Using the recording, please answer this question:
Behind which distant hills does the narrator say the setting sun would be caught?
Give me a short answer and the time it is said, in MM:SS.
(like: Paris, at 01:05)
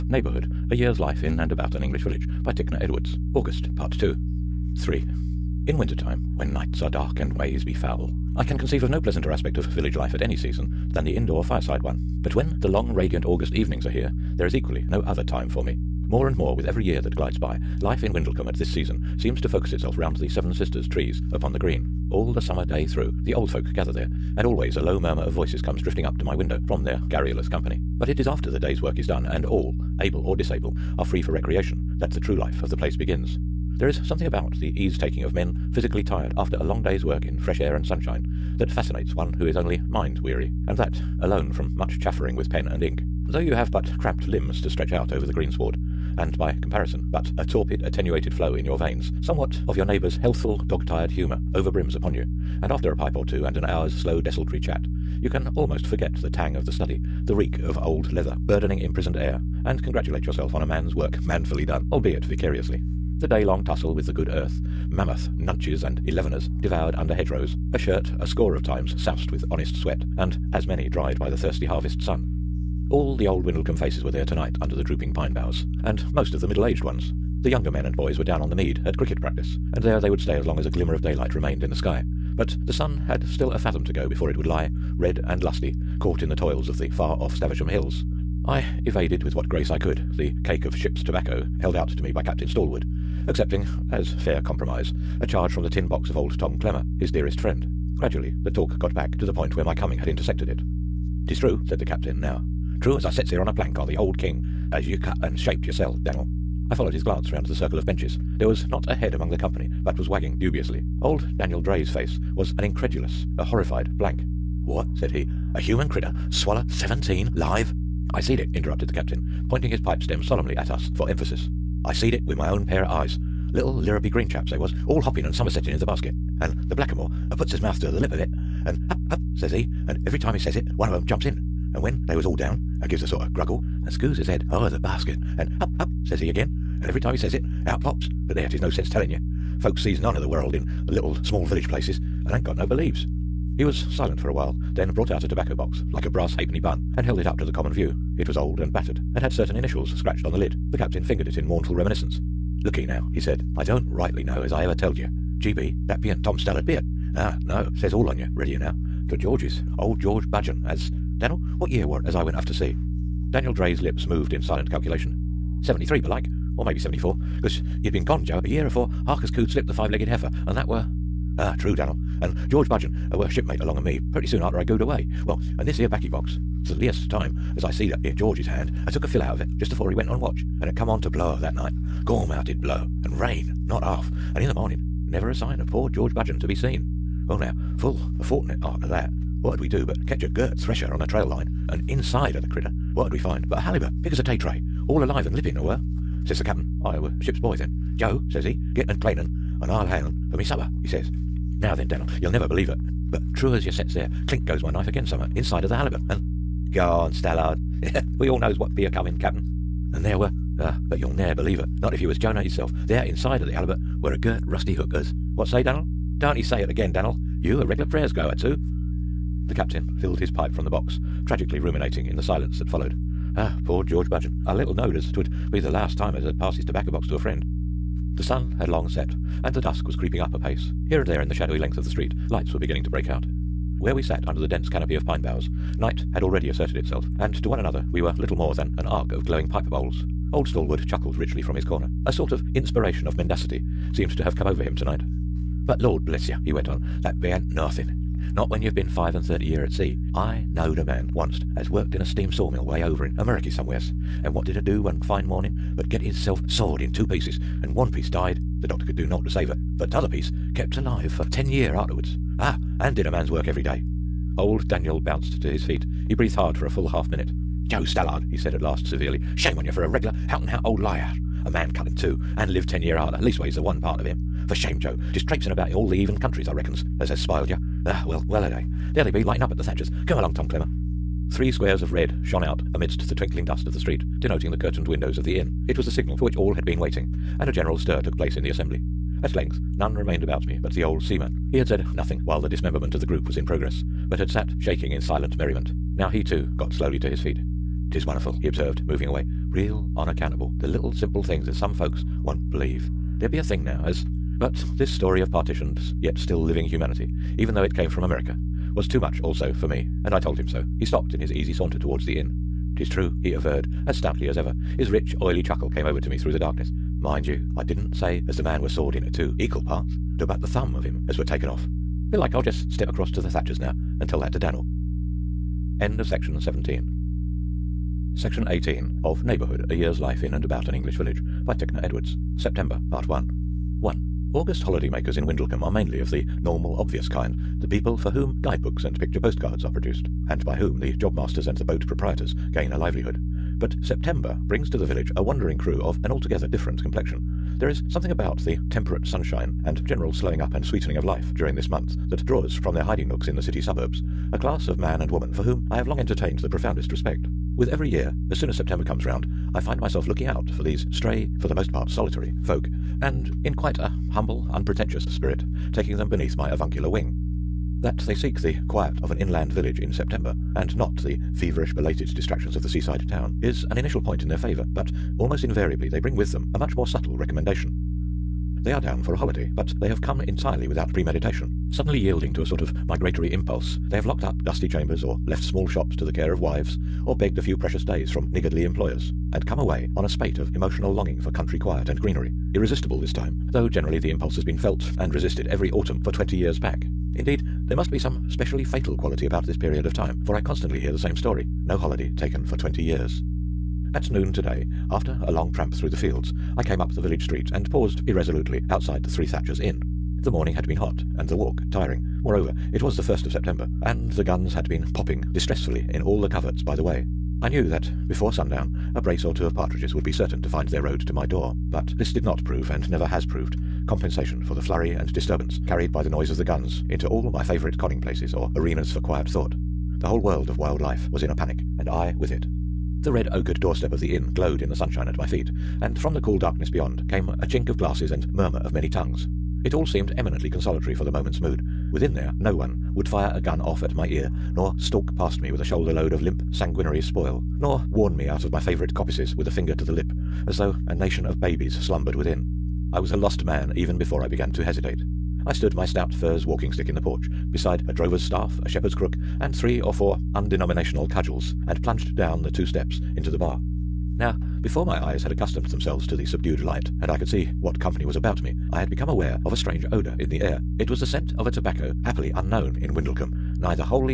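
Staversham hills, at 01:27.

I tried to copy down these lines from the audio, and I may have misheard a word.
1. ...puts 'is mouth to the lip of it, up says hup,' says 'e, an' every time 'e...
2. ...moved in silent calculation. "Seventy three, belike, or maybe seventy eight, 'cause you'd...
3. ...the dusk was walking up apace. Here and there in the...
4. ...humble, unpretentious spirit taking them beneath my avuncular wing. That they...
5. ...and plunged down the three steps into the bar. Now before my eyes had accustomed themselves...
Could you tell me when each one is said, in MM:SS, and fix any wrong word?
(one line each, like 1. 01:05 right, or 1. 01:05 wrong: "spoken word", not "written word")
1. 02:07 right
2. 02:44 wrong: "four", not "eight"
3. 03:49 wrong: "creeping", not "walking"
4. 06:04 right
5. 07:41 wrong: "two", not "three".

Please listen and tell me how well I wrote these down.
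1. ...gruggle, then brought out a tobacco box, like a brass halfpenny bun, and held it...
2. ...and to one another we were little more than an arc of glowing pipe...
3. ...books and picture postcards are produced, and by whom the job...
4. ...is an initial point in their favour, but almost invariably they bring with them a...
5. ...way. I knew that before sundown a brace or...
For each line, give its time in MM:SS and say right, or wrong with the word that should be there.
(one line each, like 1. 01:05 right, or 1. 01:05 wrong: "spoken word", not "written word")
1. 02:24 wrong: "while", not "gruggle"
2. 03:57 right
3. 05:38 right
4. 06:13 right
5. 06:56 right.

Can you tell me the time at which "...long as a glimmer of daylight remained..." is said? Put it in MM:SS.
01:20.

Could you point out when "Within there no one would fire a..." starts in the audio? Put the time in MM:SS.
07:21.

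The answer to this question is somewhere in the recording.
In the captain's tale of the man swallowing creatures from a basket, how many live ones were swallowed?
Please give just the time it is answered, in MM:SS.
01:56.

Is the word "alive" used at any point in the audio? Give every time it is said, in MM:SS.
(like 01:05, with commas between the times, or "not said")
03:15, 04:20.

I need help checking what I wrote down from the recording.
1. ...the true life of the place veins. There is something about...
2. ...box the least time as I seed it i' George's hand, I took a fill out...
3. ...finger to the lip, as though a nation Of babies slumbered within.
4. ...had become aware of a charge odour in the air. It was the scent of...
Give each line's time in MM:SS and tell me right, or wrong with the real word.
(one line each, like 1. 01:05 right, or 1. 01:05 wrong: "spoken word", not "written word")
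1. 00:32 wrong: "begins", not "veins"
2. 02:56 right
3. 07:29 right
4. 07:48 wrong: "strange", not "charge".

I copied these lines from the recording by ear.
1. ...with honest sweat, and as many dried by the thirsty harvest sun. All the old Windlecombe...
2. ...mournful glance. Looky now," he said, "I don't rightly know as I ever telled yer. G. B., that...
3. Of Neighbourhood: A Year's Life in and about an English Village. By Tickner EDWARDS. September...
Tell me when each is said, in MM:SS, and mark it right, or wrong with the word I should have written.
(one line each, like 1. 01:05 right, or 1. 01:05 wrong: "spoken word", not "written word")
1. 01:09 right
2. 02:31 wrong: "reminiscence", not "glance"
3. 05:29 right.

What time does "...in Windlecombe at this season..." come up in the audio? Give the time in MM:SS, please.
00:18.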